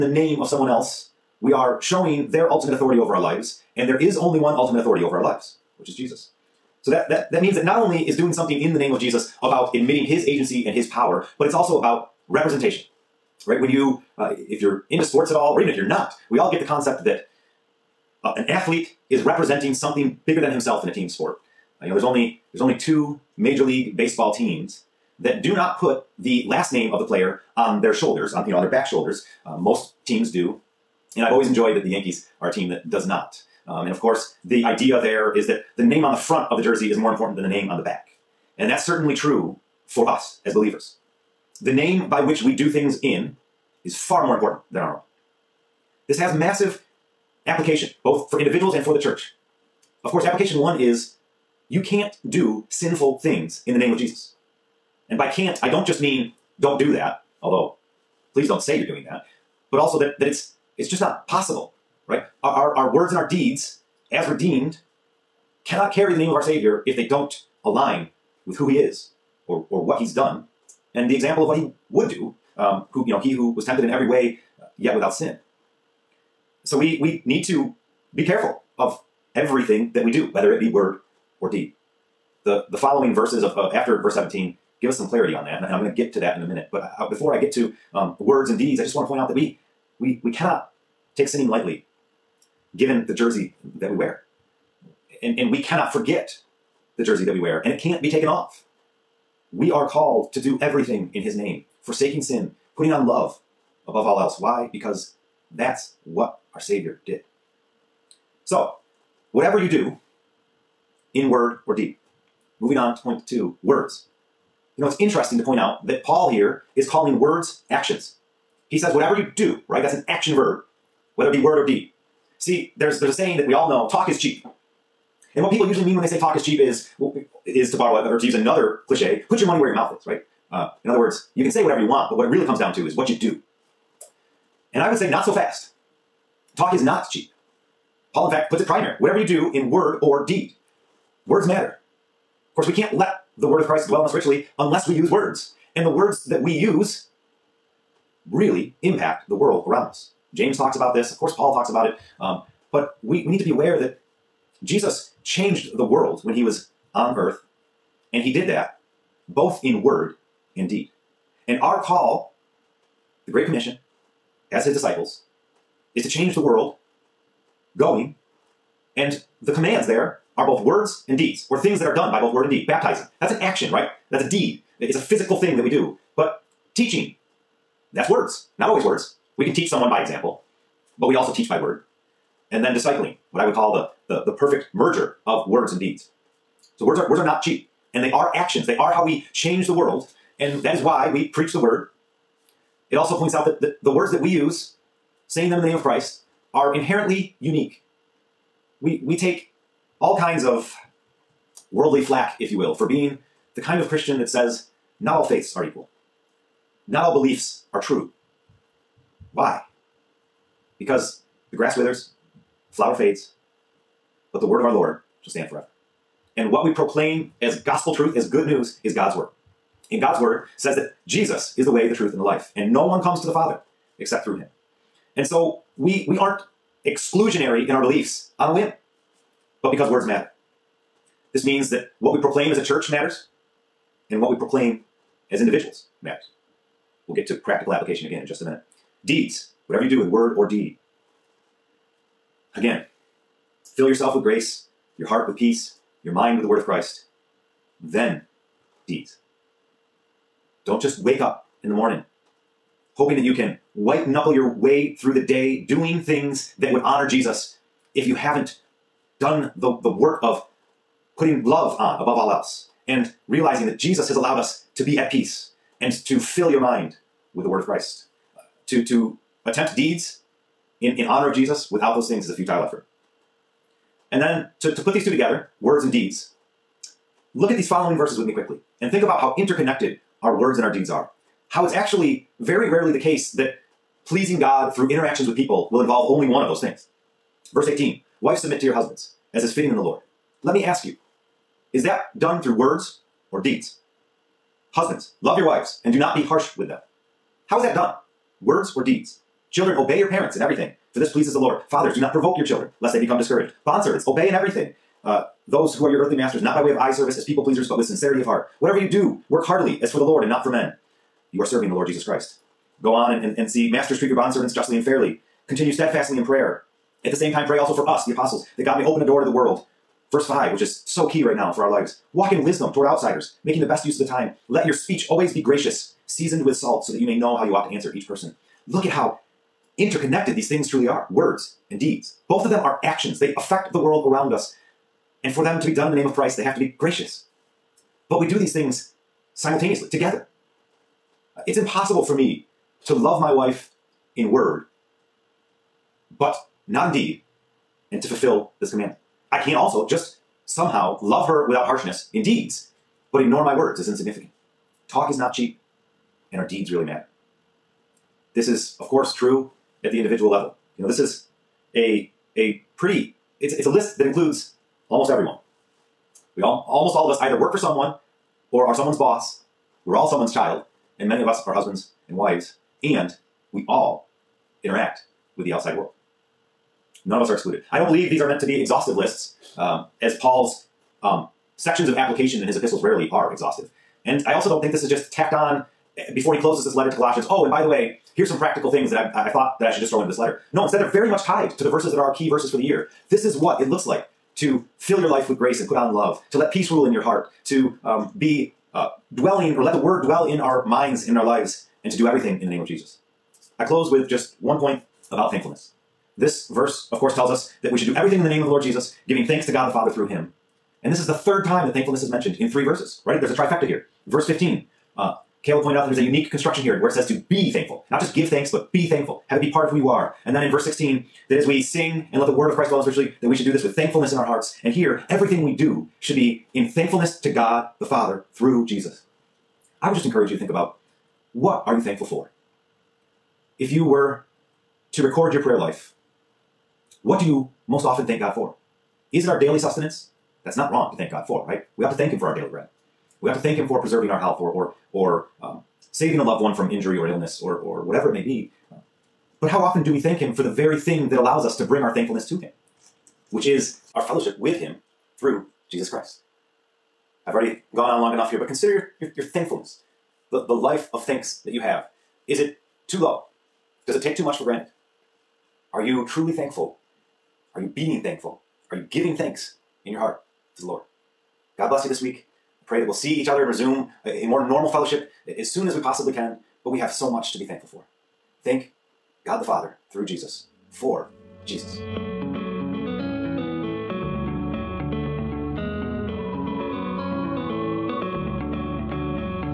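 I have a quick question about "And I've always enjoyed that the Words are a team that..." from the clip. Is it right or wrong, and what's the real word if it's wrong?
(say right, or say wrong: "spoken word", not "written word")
wrong: "Yankees", not "Words".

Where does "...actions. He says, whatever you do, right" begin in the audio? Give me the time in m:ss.
1:57.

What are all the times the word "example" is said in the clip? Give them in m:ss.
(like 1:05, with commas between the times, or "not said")
1:11, 3:00.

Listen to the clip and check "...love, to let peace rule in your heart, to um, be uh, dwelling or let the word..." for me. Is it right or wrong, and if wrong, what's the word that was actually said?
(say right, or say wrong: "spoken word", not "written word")
right.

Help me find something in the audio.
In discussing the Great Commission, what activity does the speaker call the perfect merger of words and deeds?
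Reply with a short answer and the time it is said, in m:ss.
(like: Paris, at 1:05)
Discipling, at 3:02.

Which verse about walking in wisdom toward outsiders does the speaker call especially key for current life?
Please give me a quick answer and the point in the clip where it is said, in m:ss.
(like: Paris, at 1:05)
Verse 5, at 5:20.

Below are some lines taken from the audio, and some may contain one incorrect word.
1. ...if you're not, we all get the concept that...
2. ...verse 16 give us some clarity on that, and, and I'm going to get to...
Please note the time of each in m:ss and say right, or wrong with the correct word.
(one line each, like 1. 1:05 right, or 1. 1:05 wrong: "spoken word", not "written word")
1. 0:15 right
2. 1:24 wrong: "17", not "16".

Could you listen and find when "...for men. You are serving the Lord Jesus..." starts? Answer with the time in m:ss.
5:10.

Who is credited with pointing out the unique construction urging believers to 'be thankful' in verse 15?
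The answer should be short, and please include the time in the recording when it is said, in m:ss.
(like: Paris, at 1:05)
Caleb, at 6:55.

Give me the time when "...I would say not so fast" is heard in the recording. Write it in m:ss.
2:14.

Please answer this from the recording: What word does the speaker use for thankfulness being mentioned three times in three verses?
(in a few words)
Trifecta.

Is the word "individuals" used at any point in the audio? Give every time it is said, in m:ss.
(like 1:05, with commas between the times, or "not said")
0:48, 3:55, 5:59.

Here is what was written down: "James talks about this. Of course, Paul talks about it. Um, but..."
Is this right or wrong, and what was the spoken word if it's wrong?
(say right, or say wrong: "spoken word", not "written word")
right.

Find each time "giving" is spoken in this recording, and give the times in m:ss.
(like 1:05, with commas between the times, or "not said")
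6:49, 7:48.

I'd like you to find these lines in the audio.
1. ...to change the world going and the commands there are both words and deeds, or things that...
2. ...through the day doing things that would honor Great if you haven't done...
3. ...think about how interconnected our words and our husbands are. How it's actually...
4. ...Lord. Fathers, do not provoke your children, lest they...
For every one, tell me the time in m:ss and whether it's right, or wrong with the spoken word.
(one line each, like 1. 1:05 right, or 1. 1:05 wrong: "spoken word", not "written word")
1. 2:46 right
2. 4:14 wrong: "Jesus", not "Great"
3. 4:38 wrong: "deeds", not "husbands"
4. 5:01 right.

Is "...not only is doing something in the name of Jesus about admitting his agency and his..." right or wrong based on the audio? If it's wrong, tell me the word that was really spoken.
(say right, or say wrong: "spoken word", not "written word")
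right.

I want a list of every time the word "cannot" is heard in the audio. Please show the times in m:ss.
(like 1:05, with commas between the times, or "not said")
1:05, 1:30, 1:35.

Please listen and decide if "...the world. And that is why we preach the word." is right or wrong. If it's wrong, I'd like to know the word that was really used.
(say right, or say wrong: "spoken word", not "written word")
right.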